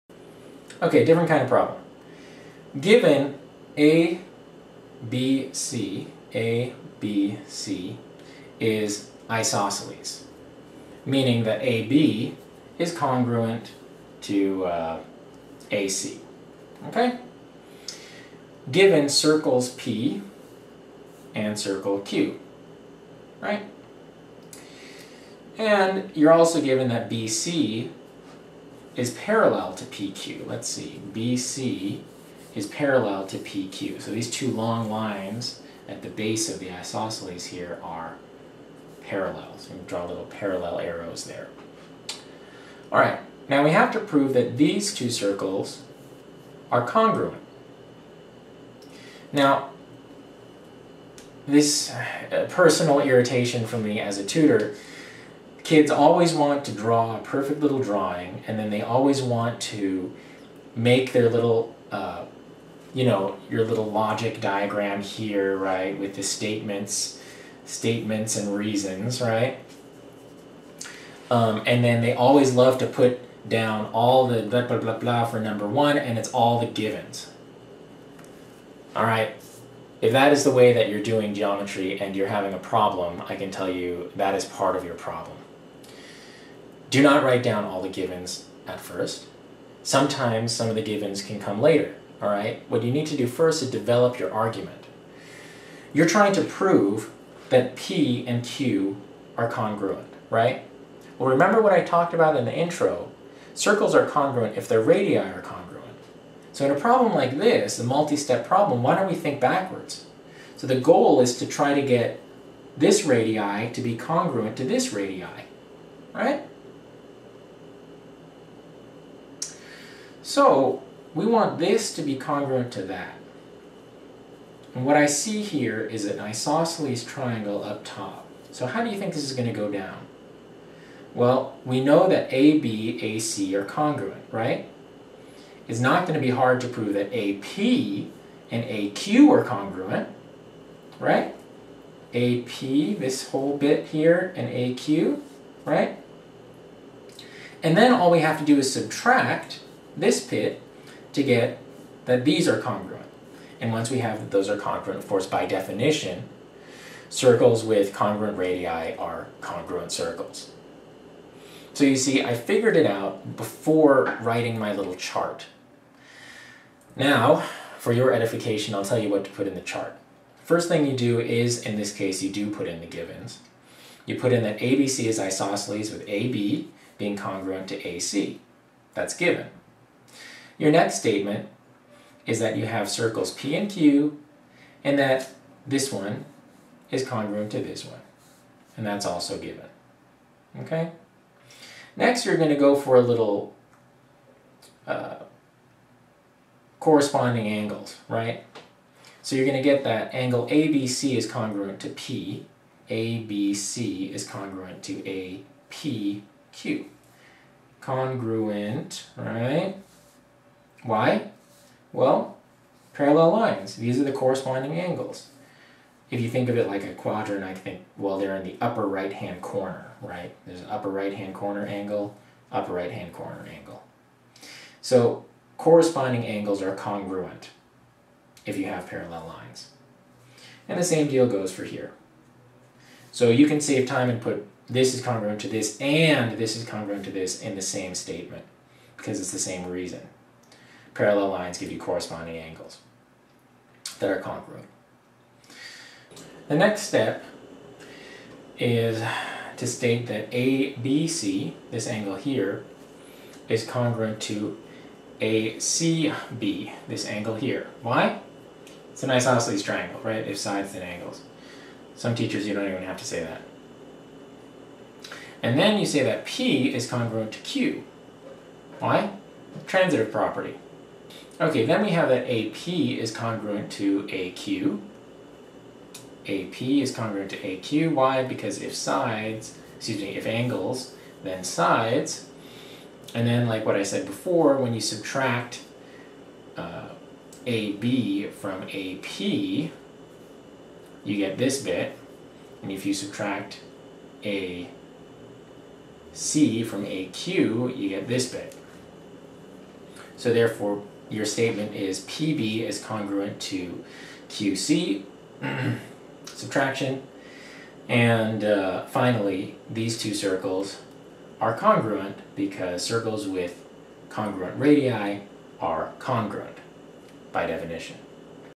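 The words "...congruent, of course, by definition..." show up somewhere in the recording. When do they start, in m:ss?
2:34.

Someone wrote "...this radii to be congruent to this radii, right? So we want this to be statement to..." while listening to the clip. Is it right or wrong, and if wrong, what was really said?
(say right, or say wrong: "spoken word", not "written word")
wrong: "congruent", not "statement".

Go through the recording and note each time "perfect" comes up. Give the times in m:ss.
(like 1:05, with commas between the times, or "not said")
0:57.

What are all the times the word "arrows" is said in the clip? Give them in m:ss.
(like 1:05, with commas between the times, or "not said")
0:40.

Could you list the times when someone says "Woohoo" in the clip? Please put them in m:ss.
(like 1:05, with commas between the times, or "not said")
not said.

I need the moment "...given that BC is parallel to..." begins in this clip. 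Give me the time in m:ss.
0:26.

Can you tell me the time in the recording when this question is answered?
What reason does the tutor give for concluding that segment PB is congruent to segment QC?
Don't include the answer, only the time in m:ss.
5:06.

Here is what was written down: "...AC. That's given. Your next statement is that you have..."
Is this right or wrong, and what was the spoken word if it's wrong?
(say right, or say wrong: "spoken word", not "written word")
right.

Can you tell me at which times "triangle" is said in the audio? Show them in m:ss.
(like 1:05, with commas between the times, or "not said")
2:07, 4:19.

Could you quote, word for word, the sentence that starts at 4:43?
And then, like what I said before, when you subtract uh, AB from AP, you get this bit.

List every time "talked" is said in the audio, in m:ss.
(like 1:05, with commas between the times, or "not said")
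1:41.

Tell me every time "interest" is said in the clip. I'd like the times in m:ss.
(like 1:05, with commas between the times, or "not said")
not said.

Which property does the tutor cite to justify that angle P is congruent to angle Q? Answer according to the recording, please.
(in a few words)
Transitive property.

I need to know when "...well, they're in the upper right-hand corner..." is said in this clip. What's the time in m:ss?
3:37.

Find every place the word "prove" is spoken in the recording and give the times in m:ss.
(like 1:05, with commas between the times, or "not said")
0:43, 1:36, 2:16.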